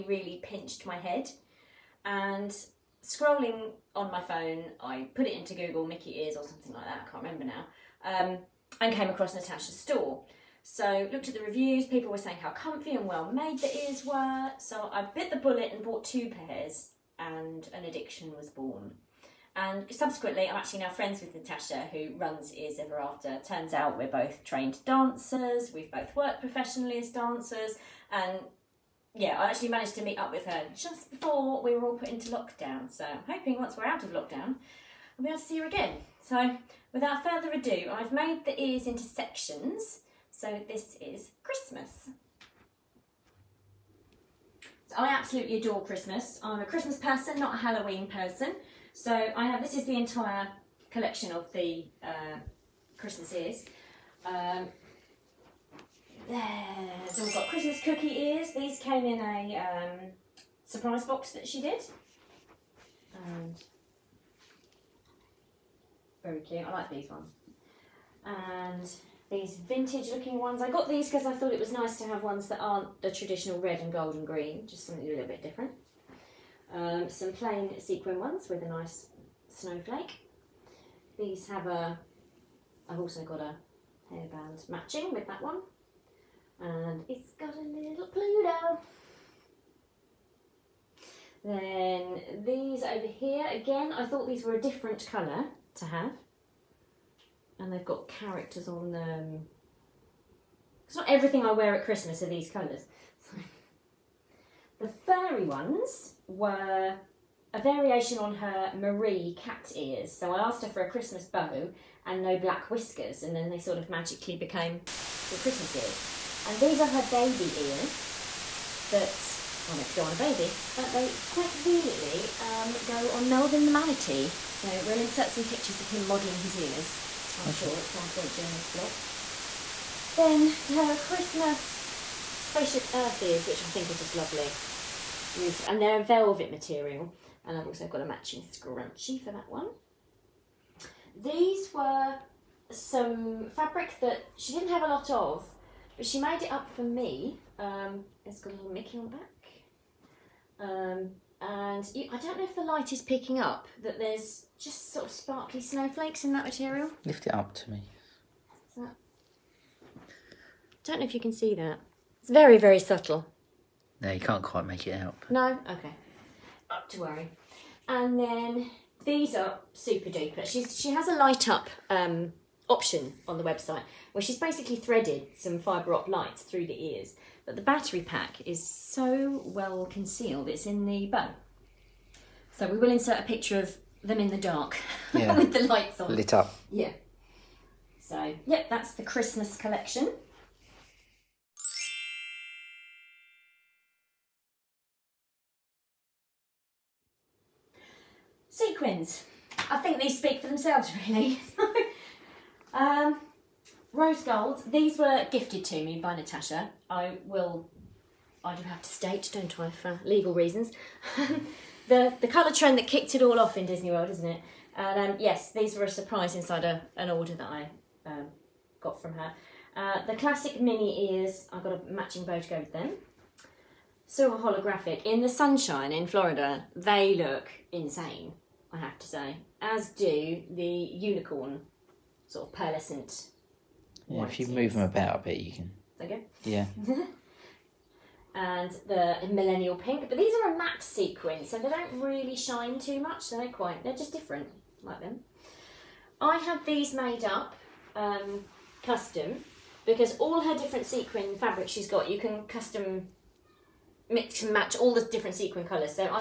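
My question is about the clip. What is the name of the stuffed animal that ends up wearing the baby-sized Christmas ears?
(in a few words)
Melvin the manatee.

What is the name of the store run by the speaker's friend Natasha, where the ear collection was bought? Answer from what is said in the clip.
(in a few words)
Ears Ever After.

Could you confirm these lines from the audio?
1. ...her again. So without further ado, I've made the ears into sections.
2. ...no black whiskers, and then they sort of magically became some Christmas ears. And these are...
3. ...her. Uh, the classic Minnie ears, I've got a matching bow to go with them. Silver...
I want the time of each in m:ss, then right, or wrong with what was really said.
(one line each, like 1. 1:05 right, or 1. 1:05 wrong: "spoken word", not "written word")
1. 0:35 right
2. 1:52 right
3. 3:39 right.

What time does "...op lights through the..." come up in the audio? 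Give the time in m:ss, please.
2:55.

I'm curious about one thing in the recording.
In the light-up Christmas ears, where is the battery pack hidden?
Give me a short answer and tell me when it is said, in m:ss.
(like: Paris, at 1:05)
In the bow, at 3:00.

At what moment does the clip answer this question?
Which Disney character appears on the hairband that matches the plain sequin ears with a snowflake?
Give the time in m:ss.
1:28.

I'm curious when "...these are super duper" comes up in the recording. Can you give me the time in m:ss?
2:49.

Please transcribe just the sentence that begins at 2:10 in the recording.
Then her Christmas Spaceship Earth ears, which I think are just lovely.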